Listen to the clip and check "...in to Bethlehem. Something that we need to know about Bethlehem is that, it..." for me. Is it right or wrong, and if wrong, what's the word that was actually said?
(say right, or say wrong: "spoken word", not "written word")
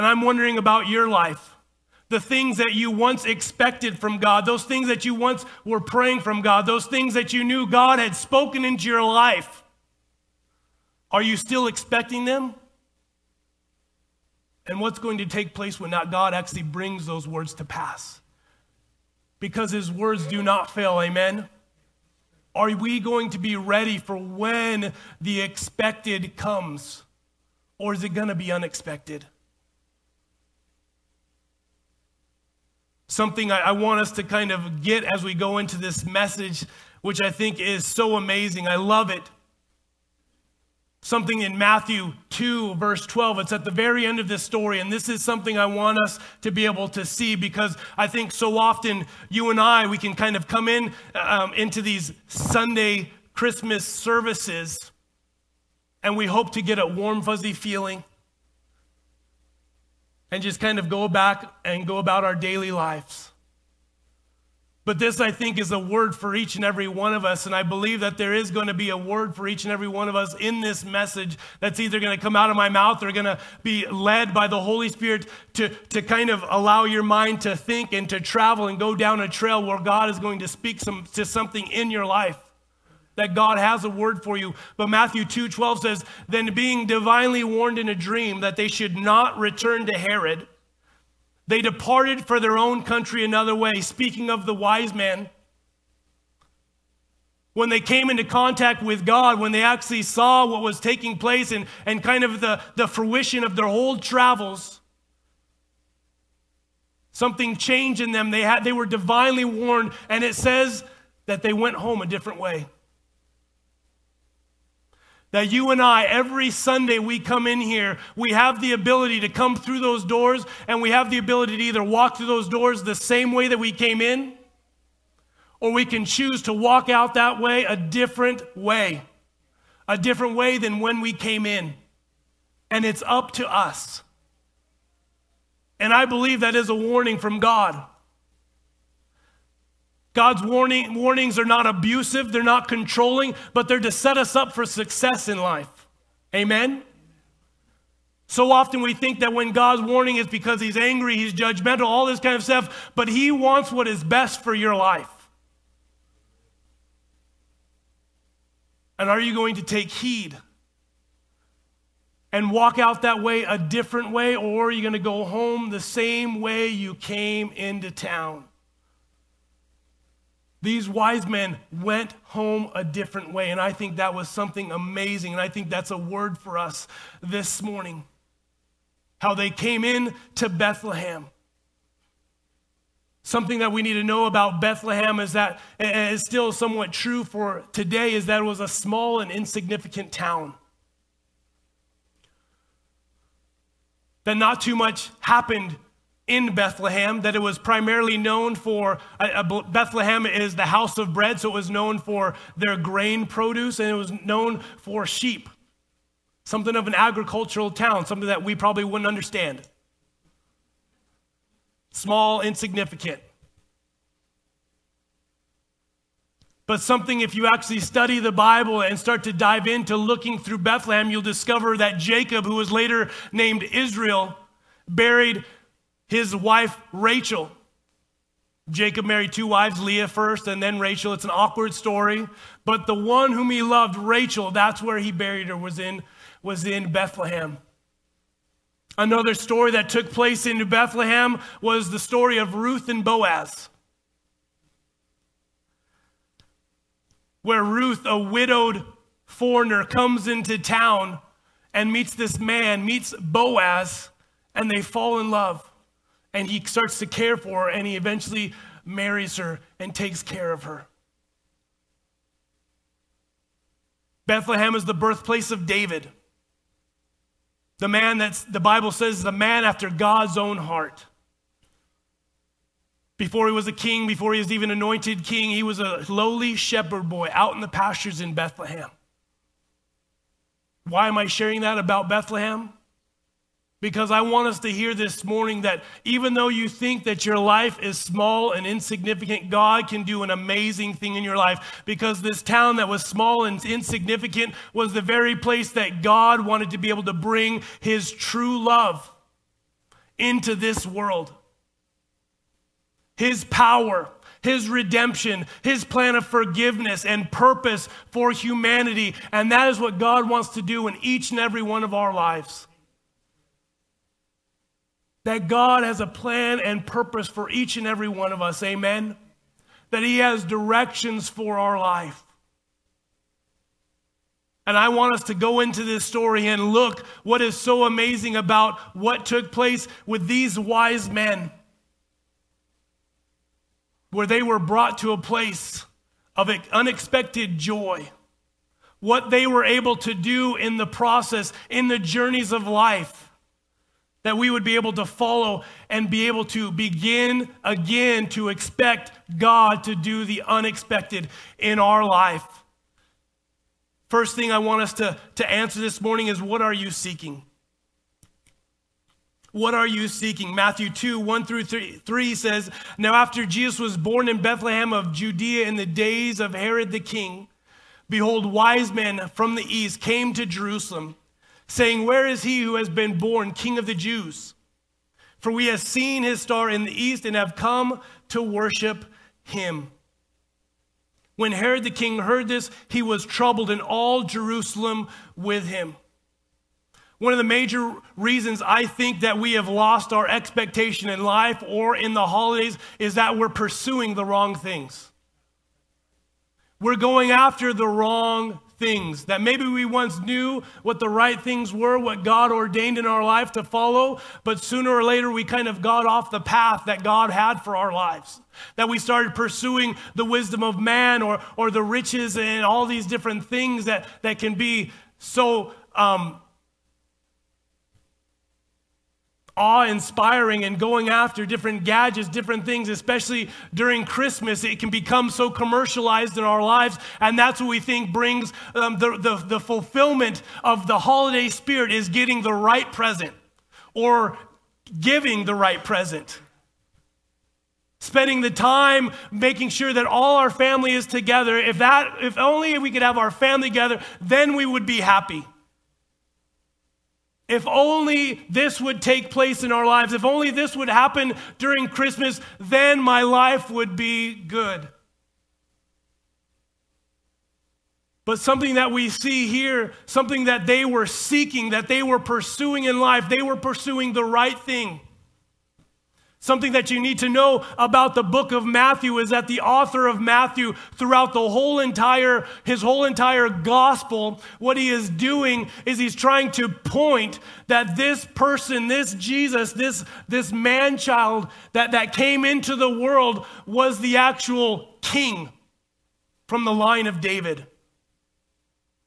right.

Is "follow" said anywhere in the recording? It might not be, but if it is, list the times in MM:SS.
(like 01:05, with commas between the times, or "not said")
05:45, 06:43.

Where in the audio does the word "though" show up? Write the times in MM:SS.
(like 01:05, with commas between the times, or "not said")
04:46.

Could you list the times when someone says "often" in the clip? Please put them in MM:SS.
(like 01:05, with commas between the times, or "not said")
00:48, 02:28.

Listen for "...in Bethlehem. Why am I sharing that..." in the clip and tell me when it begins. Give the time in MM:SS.
04:38.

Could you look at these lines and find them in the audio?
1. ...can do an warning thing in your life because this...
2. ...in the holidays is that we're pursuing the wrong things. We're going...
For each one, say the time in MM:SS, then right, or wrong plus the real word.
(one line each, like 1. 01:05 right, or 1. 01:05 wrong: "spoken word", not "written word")
1. 04:49 wrong: "amazing", not "warning"
2. 06:31 right.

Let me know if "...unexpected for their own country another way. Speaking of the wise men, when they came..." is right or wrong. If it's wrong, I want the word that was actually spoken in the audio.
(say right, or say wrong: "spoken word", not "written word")
wrong: "departed", not "unexpected".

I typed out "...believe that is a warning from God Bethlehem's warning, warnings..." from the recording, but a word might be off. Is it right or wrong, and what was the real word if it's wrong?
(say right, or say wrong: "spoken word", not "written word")
wrong: "God", not "Bethlehem".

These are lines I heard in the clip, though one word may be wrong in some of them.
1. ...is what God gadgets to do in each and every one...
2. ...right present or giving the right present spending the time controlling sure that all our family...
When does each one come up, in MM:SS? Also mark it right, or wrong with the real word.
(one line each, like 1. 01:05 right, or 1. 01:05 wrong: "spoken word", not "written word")
1. 05:09 wrong: "wants", not "gadgets"
2. 07:12 wrong: "making", not "controlling".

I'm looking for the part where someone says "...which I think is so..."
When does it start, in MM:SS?
00:37.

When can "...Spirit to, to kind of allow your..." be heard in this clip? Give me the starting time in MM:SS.
01:14.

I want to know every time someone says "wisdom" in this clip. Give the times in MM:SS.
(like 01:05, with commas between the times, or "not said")
06:50.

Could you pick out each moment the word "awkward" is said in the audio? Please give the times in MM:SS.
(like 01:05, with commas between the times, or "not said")
03:51.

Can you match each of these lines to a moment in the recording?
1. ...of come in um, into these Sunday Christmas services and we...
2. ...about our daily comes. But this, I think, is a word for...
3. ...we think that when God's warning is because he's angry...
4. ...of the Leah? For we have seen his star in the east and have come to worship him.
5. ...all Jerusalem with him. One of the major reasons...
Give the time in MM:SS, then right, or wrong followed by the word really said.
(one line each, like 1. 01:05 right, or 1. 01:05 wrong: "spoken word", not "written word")
1. 00:50 right
2. 01:01 wrong: "lives", not "comes"
3. 02:28 right
4. 06:13 wrong: "Jews", not "Leah"
5. 06:23 right.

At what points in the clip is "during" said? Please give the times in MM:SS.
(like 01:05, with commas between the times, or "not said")
07:03, 07:31.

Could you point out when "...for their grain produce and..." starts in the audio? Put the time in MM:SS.
03:21.